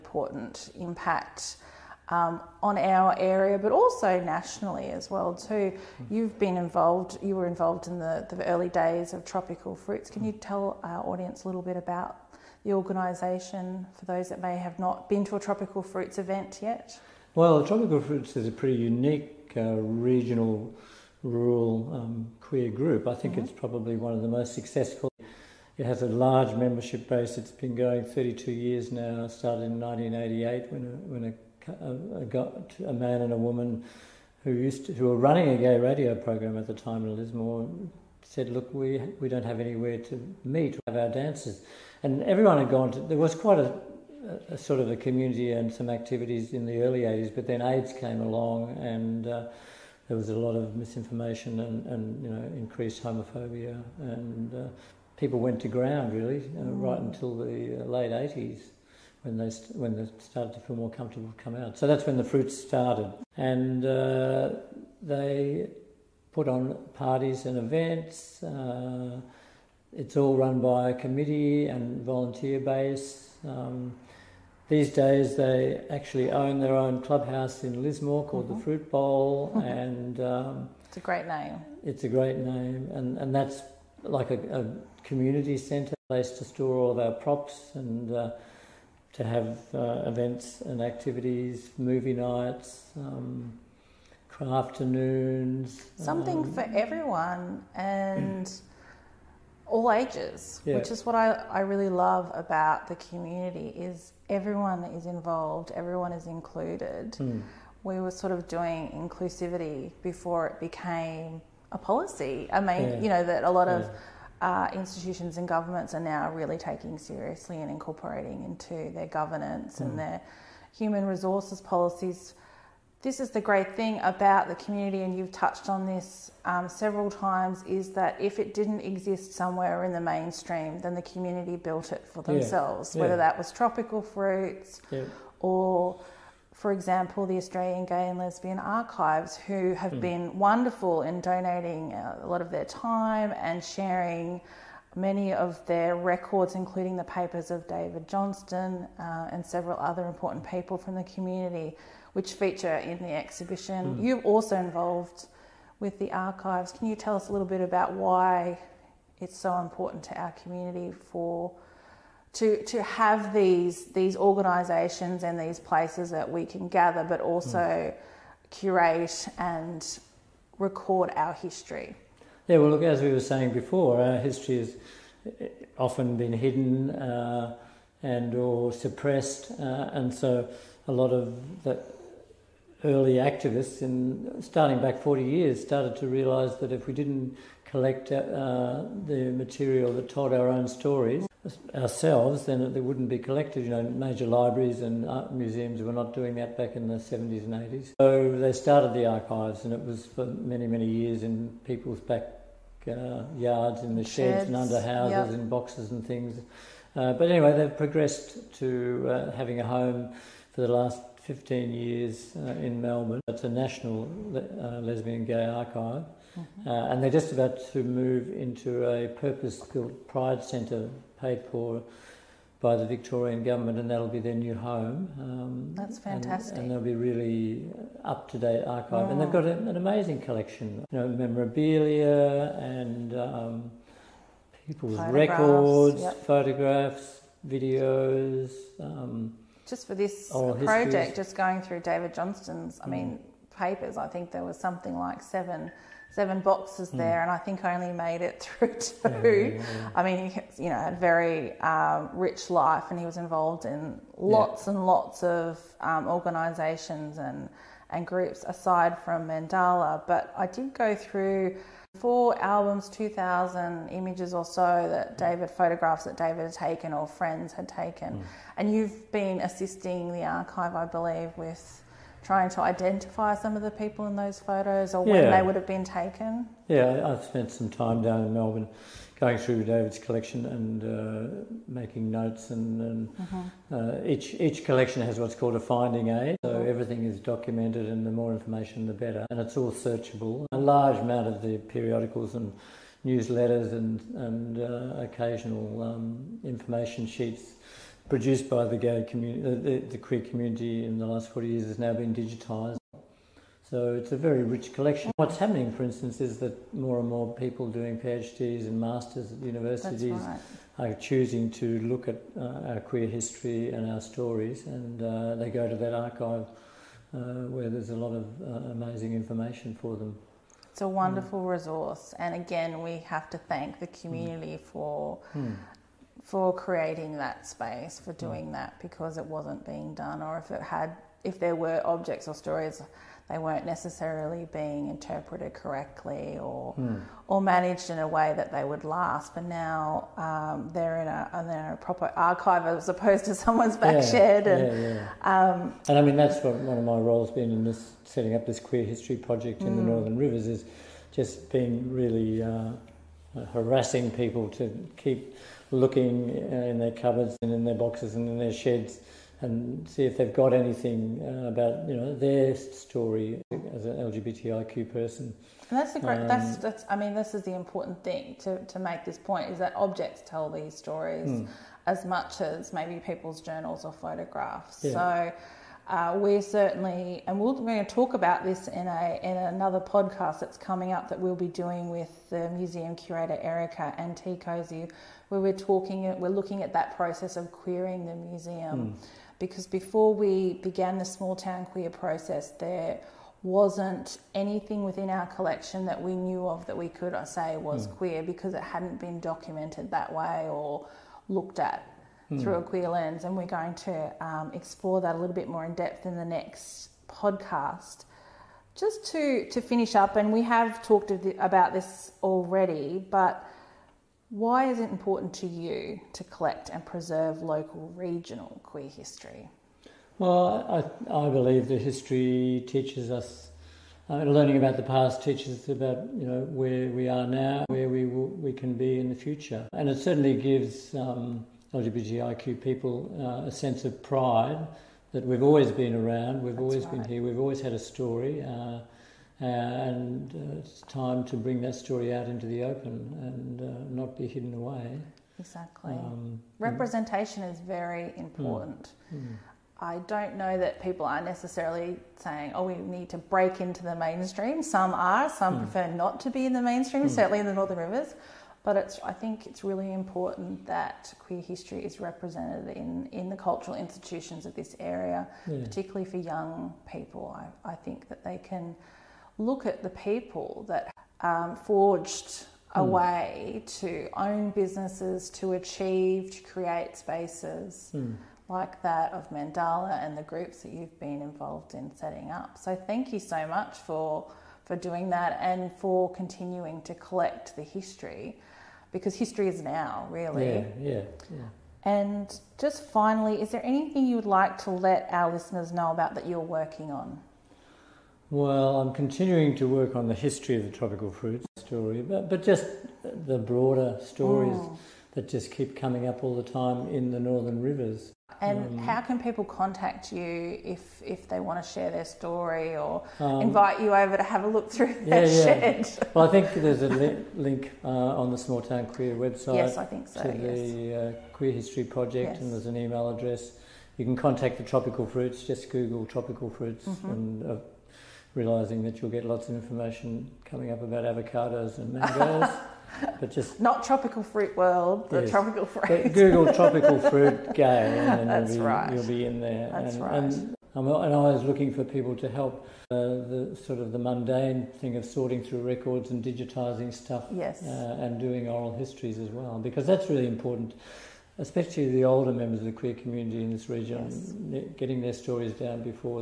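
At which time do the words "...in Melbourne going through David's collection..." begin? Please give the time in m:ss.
4:38.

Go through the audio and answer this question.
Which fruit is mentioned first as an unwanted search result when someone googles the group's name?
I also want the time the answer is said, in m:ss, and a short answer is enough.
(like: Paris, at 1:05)
avocados, at 8:51.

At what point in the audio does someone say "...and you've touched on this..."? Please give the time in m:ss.
2:05.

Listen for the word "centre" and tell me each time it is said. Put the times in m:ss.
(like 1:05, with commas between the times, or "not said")
1:25, 3:40.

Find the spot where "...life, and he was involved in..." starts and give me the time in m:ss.
4:12.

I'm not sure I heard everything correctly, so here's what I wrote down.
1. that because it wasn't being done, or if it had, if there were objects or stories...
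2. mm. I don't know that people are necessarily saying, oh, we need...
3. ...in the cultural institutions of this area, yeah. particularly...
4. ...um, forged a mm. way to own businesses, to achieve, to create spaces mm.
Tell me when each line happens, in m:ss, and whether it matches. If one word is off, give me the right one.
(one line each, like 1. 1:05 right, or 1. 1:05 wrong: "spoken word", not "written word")
1. 5:28 right
2. 7:29 right
3. 7:43 right
4. 7:51 right.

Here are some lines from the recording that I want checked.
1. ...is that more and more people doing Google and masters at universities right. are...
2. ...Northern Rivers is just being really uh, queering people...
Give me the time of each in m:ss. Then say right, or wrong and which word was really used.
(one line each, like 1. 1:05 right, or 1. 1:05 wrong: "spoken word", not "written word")
1. 5:06 wrong: "PhDs", not "Google"
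2. 5:49 wrong: "harassing", not "queering".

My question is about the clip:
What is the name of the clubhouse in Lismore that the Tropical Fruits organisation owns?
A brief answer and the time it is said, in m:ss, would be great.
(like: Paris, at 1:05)
the Fruit Bowl, at 1:18.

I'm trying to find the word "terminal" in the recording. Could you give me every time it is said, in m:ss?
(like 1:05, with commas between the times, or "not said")
not said.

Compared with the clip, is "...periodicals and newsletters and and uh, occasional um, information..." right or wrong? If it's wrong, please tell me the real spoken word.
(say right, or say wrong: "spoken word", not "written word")
right.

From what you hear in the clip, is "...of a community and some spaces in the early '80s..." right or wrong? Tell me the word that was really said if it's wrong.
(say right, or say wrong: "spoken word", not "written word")
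wrong: "activities", not "spaces".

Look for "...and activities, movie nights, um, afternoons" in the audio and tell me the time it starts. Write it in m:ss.
1:30.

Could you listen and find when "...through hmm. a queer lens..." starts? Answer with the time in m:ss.
6:42.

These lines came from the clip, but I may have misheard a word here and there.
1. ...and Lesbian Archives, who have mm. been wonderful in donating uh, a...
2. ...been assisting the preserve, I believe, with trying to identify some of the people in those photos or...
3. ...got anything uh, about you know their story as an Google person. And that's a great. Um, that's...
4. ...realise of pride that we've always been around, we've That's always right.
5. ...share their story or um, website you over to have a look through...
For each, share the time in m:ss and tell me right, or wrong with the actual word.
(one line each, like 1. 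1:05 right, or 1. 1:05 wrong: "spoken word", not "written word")
1. 2:18 right
2. 4:29 wrong: "archive", not "preserve"
3. 6:00 wrong: "LGBTIQ", not "Google"
4. 7:13 wrong: "sense", not "realise"
5. 8:31 wrong: "invite", not "website".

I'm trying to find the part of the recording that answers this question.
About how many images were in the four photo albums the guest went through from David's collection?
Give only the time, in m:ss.
4:22.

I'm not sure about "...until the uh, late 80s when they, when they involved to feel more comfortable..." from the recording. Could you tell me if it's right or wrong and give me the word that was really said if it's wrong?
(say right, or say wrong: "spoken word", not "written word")
wrong: "started", not "involved".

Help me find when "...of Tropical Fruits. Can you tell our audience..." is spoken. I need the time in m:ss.
0:09.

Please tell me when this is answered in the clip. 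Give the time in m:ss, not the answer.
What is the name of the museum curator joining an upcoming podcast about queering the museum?
6:23.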